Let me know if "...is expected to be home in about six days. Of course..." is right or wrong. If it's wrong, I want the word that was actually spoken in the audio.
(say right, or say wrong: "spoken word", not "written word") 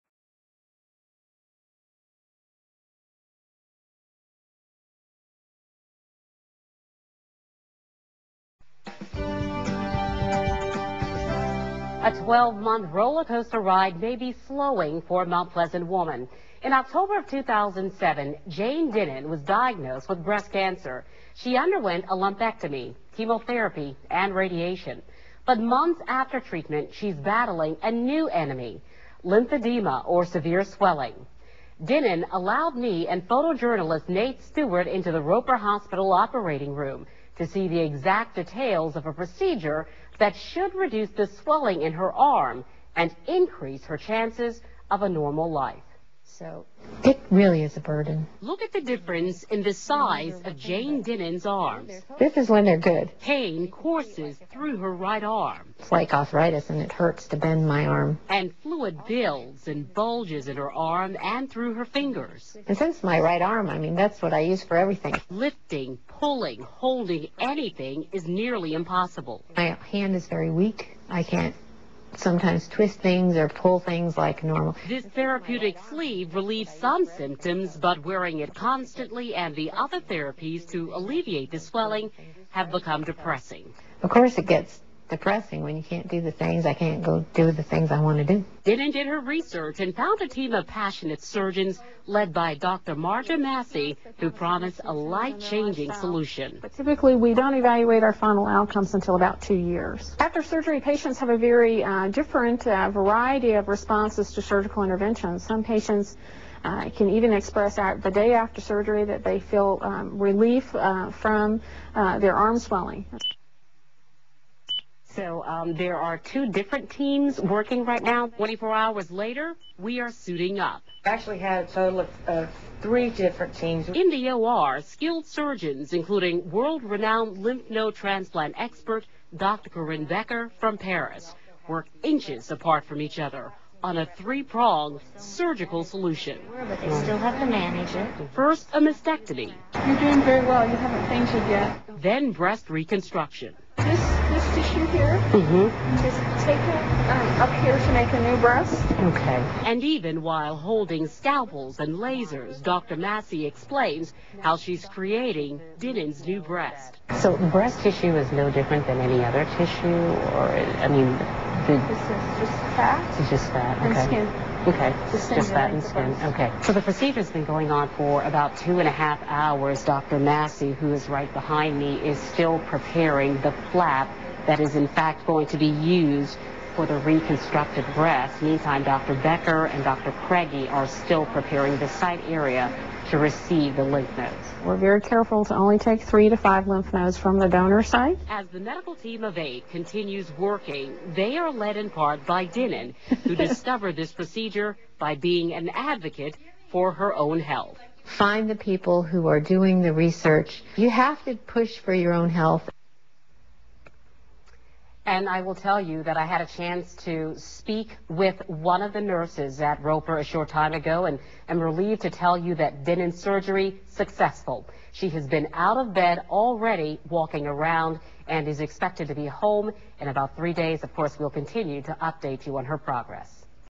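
wrong: "three", not "six".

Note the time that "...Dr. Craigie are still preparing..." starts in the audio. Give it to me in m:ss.
2:59.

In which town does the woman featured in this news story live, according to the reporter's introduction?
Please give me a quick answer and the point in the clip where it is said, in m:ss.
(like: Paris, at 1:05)
Mount Pleasant, at 0:15.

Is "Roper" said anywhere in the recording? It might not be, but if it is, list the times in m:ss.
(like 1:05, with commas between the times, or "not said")
0:35, 3:29.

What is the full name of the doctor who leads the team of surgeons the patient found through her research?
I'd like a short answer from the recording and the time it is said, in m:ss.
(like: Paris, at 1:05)
Marga Massey, at 1:32.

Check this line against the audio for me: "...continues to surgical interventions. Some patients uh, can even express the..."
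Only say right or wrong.
wrong.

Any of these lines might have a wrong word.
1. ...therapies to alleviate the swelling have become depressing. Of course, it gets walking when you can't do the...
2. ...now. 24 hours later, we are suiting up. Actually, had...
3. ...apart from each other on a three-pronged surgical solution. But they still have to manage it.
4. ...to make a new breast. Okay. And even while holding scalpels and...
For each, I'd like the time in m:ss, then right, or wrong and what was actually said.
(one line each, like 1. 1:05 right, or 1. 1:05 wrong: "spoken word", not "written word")
1. 1:20 wrong: "depressing", not "walking"
2. 1:58 right
3. 2:12 right
4. 2:27 right.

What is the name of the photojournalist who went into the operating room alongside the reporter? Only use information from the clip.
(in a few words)
Nate Stewart.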